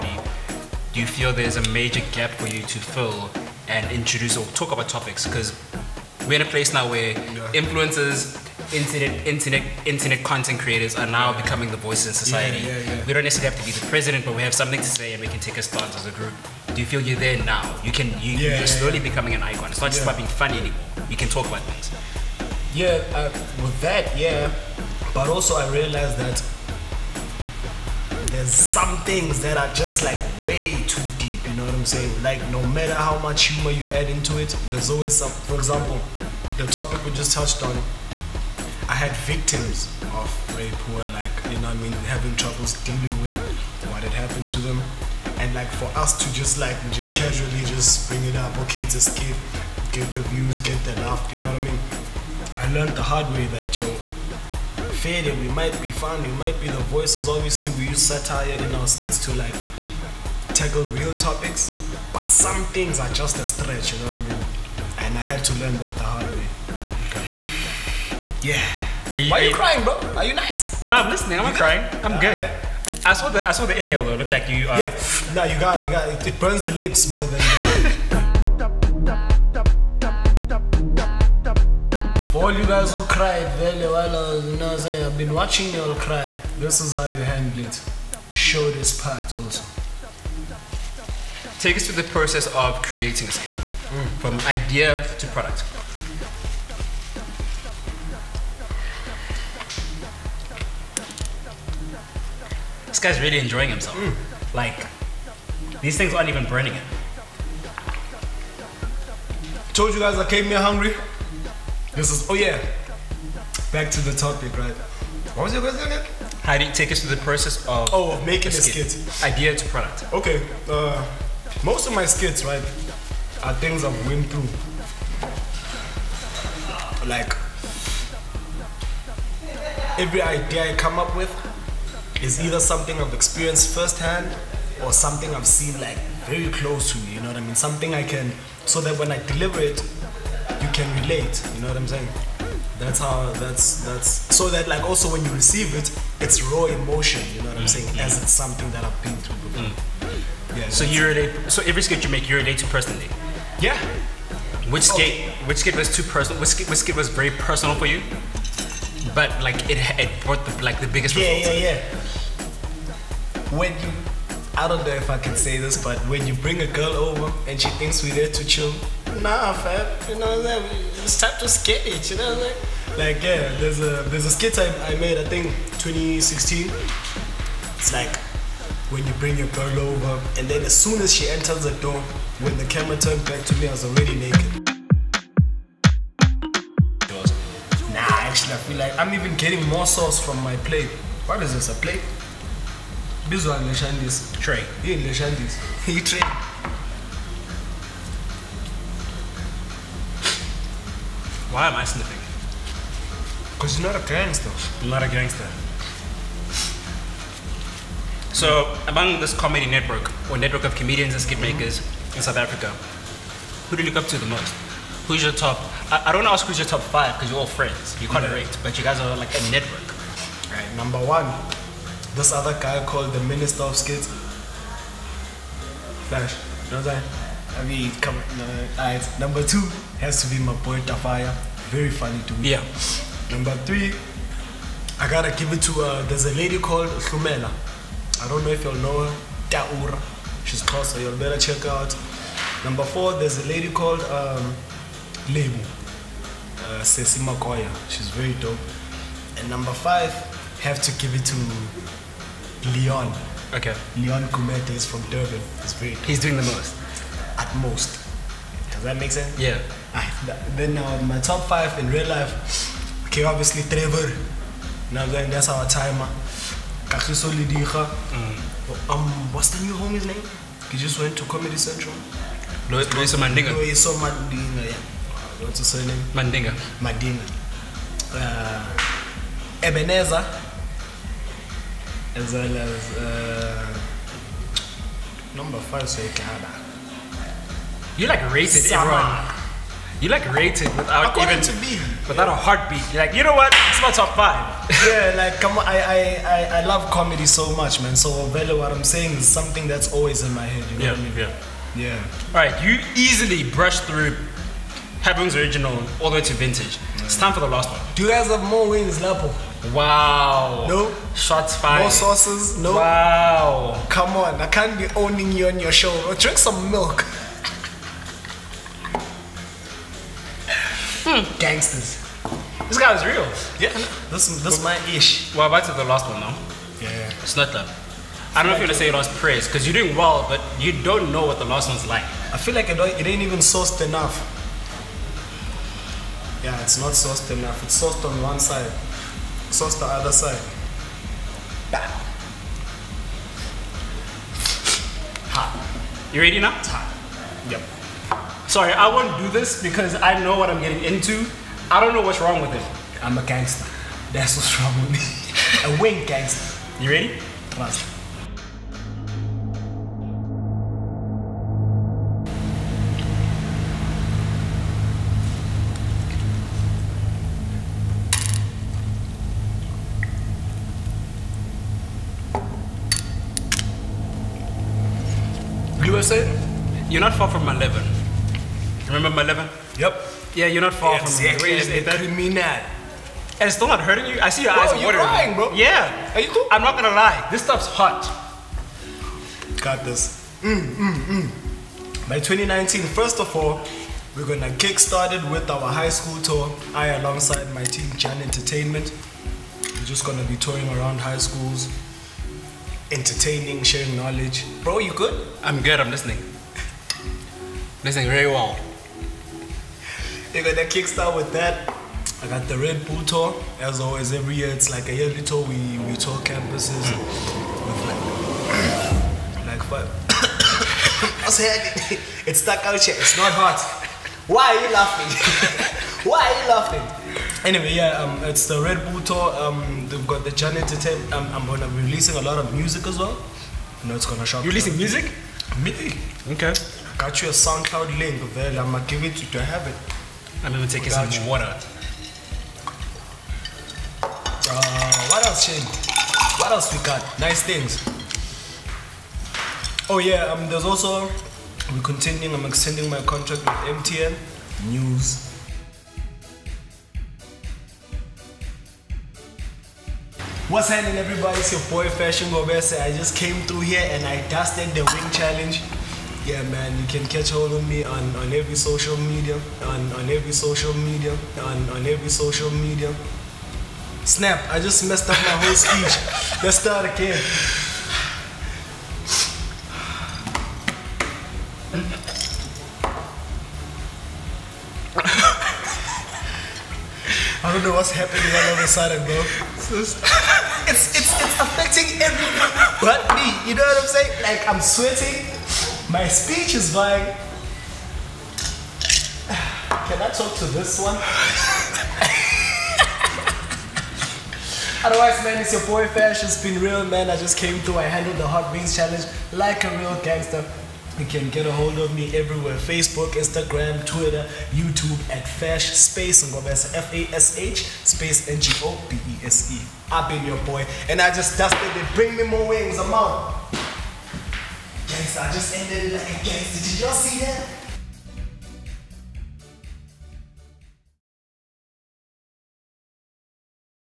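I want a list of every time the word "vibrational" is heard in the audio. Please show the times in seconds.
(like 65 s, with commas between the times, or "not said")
not said.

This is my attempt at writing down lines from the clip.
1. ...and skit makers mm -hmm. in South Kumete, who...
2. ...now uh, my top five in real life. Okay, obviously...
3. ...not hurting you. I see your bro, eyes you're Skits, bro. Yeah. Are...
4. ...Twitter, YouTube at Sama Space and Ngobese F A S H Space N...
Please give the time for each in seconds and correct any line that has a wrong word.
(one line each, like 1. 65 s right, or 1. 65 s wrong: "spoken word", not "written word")
1. 211 s wrong: "Africa", not "Kumete"
2. 260 s right
3. 383 s wrong: "Crying", not "Skits"
4. 513 s wrong: "Fash", not "Sama".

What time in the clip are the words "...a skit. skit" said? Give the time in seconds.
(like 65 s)
118 s.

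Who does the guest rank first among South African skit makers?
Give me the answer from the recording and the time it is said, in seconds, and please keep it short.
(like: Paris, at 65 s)
Flash, at 226 s.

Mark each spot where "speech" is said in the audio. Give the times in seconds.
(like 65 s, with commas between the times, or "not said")
475 s, 496 s.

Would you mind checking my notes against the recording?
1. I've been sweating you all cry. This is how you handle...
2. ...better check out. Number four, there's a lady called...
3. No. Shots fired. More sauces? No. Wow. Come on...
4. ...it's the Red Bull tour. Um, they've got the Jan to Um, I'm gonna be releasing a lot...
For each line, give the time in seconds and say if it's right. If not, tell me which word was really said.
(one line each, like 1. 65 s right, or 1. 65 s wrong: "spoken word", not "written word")
1. 85 s wrong: "watching", not "sweating"
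2. 241 s right
3. 310 s right
4. 428 s right.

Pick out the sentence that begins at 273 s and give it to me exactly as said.
Loyiso Madinga, yeah what's his surname?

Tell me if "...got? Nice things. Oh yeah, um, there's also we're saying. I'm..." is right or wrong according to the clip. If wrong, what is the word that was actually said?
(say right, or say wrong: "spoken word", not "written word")
wrong: "continuing", not "saying".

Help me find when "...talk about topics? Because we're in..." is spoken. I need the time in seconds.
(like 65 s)
4 s.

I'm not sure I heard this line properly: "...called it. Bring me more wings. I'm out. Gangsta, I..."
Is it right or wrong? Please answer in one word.
wrong.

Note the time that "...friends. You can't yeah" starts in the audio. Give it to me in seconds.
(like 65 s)
217 s.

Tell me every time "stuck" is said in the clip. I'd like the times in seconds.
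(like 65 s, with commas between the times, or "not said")
422 s.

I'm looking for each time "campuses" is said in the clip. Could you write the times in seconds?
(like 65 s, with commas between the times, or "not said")
416 s.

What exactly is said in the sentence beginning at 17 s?
You can you, yeah, you're slowly yeah.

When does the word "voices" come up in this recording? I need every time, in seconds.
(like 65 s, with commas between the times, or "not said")
11 s, 56 s.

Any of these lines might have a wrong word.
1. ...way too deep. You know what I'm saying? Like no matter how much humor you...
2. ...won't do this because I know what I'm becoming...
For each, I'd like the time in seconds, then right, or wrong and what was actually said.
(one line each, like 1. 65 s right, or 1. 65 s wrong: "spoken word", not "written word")
1. 30 s right
2. 348 s wrong: "getting", not "becoming".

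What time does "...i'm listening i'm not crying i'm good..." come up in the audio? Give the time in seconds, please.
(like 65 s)
70 s.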